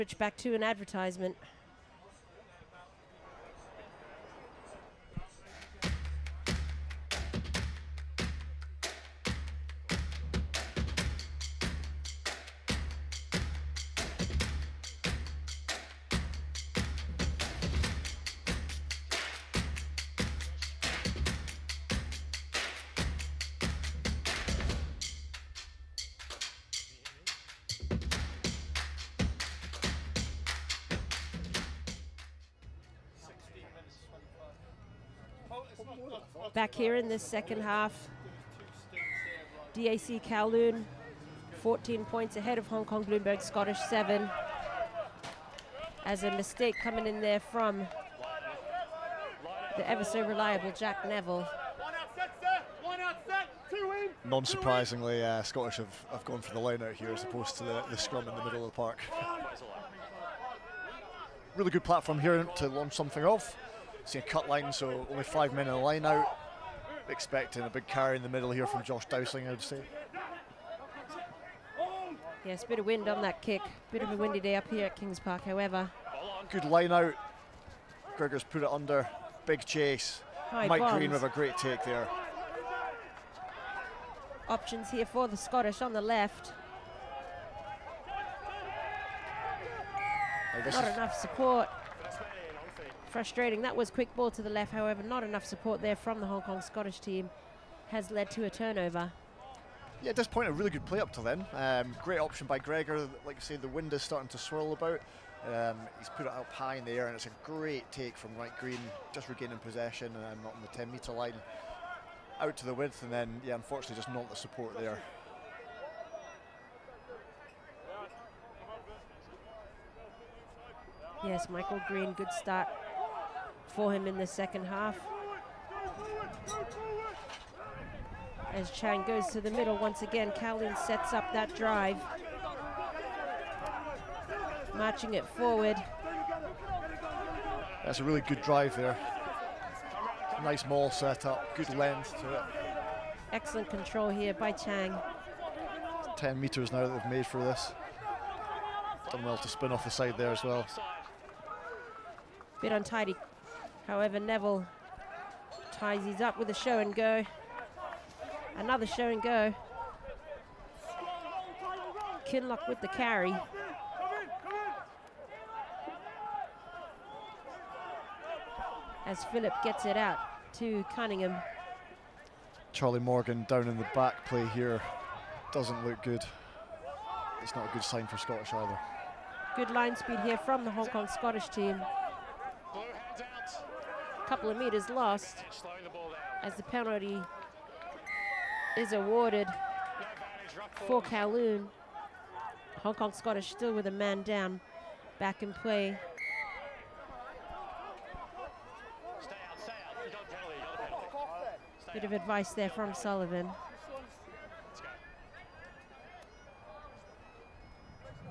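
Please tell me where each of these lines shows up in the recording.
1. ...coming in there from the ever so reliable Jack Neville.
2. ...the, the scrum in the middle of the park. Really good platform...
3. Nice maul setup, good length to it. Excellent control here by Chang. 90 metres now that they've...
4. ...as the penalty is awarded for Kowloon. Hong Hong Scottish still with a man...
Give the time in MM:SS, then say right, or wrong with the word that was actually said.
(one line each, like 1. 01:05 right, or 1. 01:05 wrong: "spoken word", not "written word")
1. 00:46 right
2. 00:57 right
3. 02:20 wrong: "10", not "90"
4. 03:06 wrong: "Kong", not "Hong".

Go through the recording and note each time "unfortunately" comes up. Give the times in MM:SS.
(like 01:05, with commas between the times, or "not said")
01:53.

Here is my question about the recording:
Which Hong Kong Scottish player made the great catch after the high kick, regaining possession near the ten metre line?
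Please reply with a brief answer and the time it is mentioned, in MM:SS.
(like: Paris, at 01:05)
Mike Green, at 01:48.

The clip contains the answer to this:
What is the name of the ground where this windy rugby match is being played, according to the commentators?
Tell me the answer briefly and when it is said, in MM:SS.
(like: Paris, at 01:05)
Kings Park, at 01:14.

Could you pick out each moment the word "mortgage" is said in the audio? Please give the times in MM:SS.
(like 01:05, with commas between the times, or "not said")
not said.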